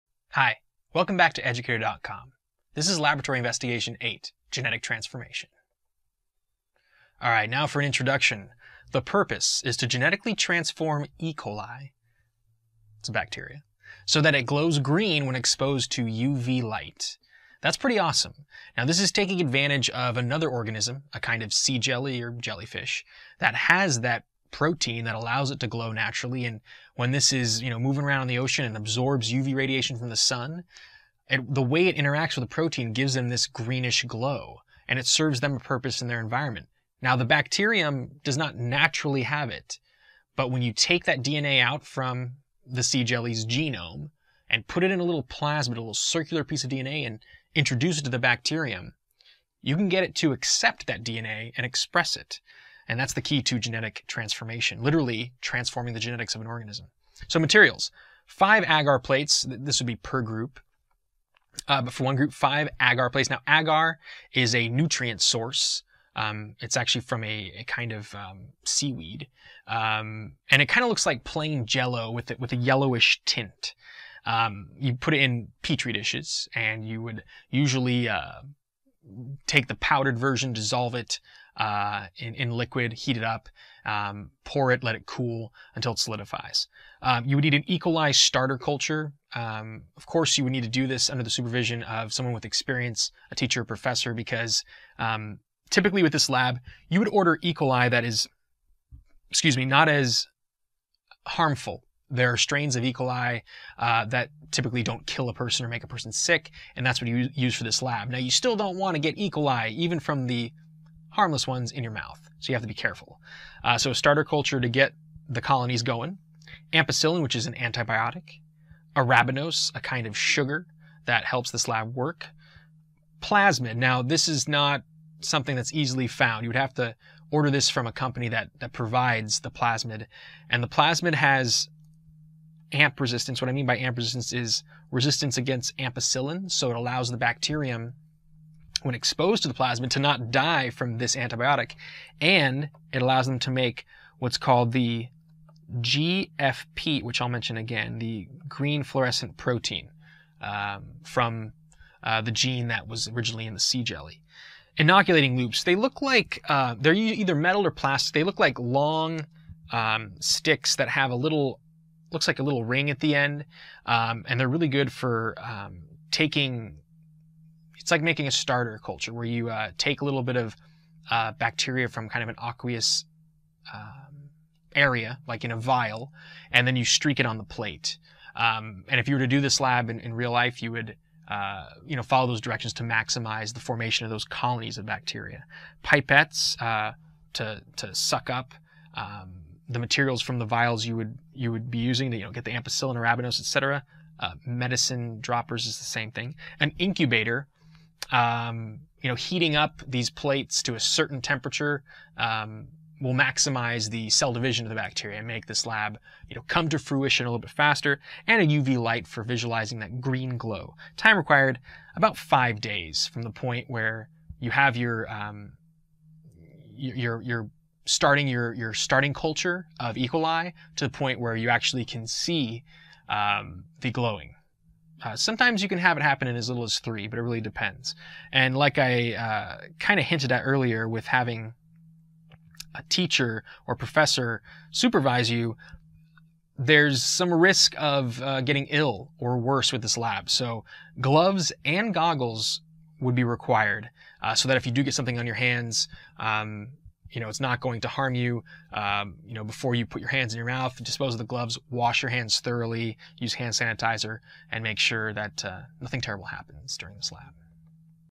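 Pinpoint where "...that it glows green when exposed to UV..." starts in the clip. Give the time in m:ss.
0:14.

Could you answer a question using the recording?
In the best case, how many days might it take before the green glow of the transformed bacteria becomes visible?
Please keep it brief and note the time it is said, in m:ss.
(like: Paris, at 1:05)
3, at 3:46.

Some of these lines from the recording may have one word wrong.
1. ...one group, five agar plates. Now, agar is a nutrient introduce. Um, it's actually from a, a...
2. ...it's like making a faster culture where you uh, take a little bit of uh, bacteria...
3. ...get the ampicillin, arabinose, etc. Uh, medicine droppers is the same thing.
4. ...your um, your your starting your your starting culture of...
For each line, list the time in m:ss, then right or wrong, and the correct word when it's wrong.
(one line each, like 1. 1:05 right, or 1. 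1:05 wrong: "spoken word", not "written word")
1. 1:02 wrong: "source", not "introduce"
2. 2:47 wrong: "starter", not "faster"
3. 3:12 right
4. 3:34 right.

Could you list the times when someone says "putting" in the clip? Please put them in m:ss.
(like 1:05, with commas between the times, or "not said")
not said.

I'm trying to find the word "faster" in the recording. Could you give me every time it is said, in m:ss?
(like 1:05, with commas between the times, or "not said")
3:27.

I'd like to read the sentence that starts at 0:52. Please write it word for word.
And that's the key to genetic transformation, literally transforming the genetics of an organism.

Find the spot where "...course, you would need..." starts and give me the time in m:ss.
1:30.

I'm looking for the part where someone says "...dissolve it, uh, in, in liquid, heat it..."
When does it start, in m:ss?
1:20.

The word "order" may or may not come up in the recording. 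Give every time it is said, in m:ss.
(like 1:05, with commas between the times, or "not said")
1:37, 2:07.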